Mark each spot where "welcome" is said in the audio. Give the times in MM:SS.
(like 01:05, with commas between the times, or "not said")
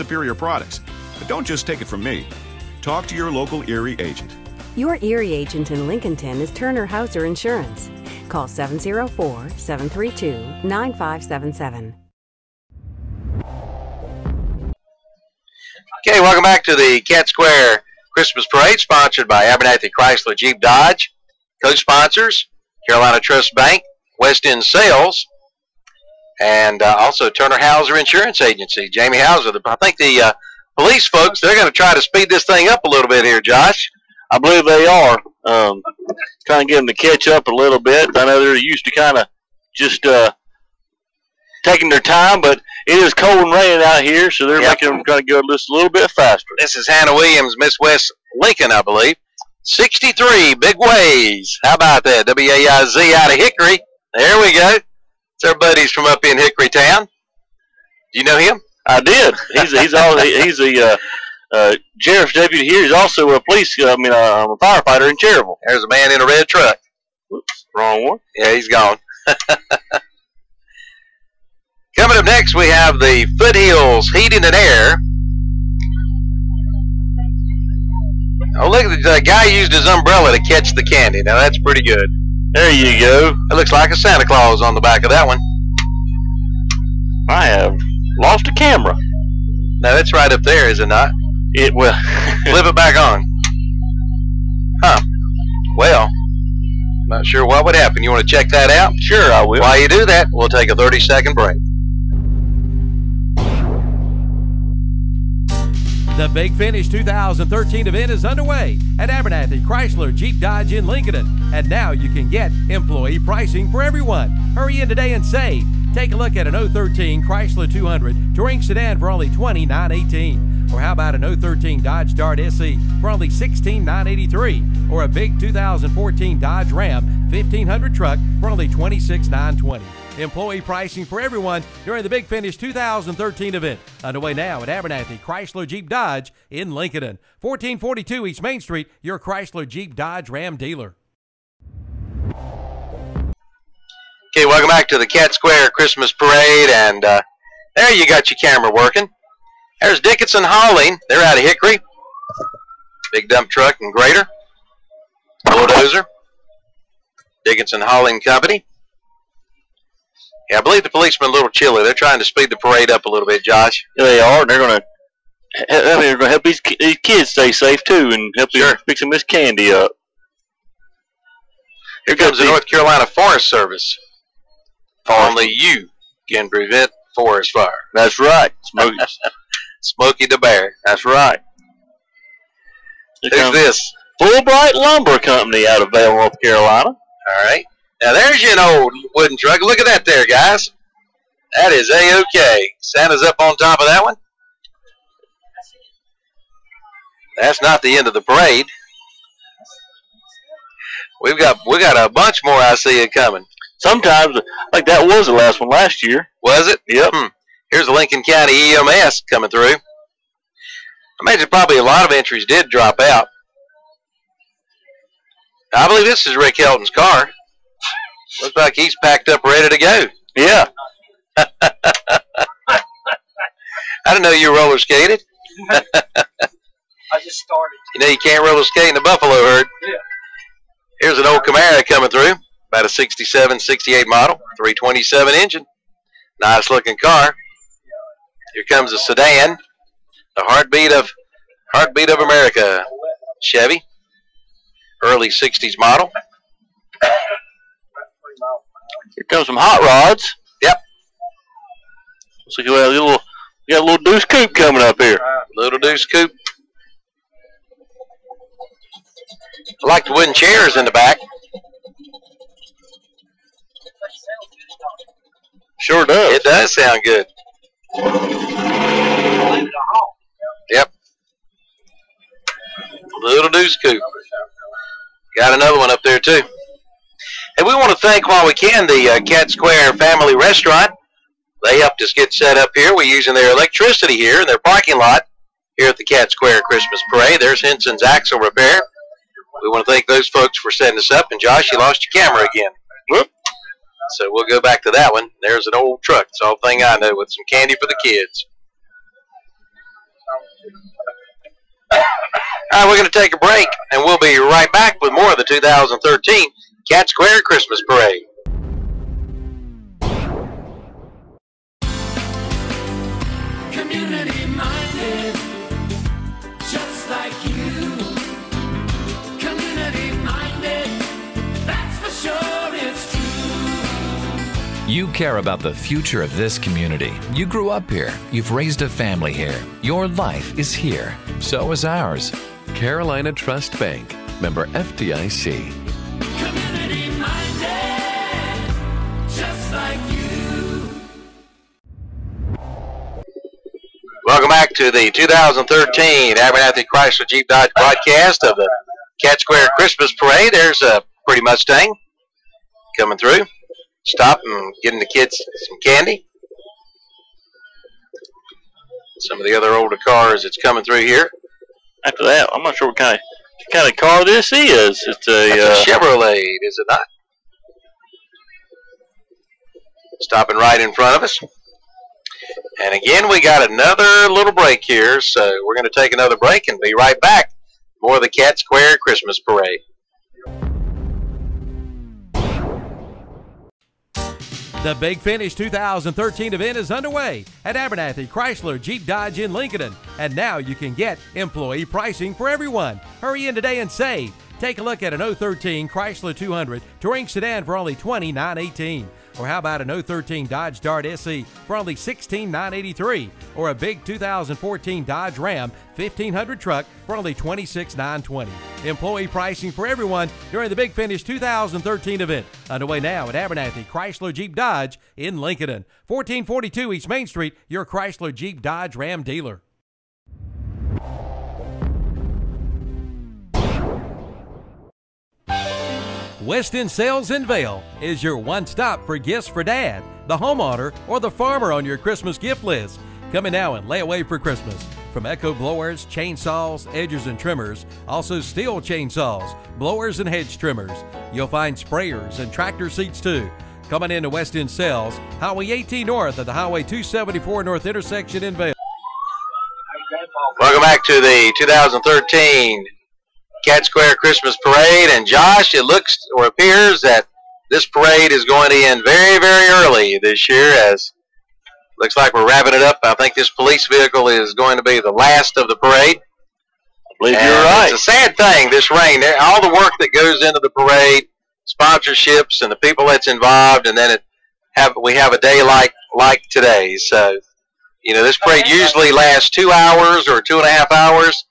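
00:16, 02:24, 05:44, 07:30.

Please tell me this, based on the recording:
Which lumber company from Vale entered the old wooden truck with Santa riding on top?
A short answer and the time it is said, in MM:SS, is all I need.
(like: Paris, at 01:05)
Fulbright Lumber Company, at 03:04.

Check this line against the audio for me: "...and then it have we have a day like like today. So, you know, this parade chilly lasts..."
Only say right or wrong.
wrong.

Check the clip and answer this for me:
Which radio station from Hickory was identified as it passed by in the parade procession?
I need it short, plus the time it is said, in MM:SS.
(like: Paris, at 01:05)
WAIZ, at 00:52.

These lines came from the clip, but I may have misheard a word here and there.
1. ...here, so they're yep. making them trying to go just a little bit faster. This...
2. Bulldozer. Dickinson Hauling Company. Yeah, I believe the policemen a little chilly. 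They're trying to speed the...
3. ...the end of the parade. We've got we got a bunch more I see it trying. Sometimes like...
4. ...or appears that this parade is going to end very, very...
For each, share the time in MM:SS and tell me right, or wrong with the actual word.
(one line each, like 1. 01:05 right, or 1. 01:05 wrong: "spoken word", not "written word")
1. 00:44 right
2. 02:35 right
3. 03:17 wrong: "coming", not "trying"
4. 07:36 right.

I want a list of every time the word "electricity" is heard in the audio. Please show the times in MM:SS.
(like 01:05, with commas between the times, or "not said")
04:43.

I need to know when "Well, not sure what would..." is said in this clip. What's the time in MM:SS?
01:35.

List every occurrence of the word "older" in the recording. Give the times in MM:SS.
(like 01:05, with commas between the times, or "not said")
05:59.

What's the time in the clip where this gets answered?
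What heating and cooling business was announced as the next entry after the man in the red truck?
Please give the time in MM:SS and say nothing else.
01:13.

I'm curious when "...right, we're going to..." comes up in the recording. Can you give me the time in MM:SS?
05:02.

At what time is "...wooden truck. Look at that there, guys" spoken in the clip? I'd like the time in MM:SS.
03:09.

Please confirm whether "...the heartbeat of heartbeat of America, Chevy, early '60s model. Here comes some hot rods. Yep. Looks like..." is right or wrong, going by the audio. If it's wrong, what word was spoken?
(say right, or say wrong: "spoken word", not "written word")
right.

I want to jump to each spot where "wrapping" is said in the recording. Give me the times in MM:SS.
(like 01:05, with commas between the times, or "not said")
07:42.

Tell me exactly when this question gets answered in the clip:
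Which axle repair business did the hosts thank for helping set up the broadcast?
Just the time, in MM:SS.
04:47.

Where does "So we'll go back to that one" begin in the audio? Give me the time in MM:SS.
04:54.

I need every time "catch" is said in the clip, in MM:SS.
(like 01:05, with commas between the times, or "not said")
00:36, 01:20.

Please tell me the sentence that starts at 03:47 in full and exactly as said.
You know you can't roller skate in the buffalo herd.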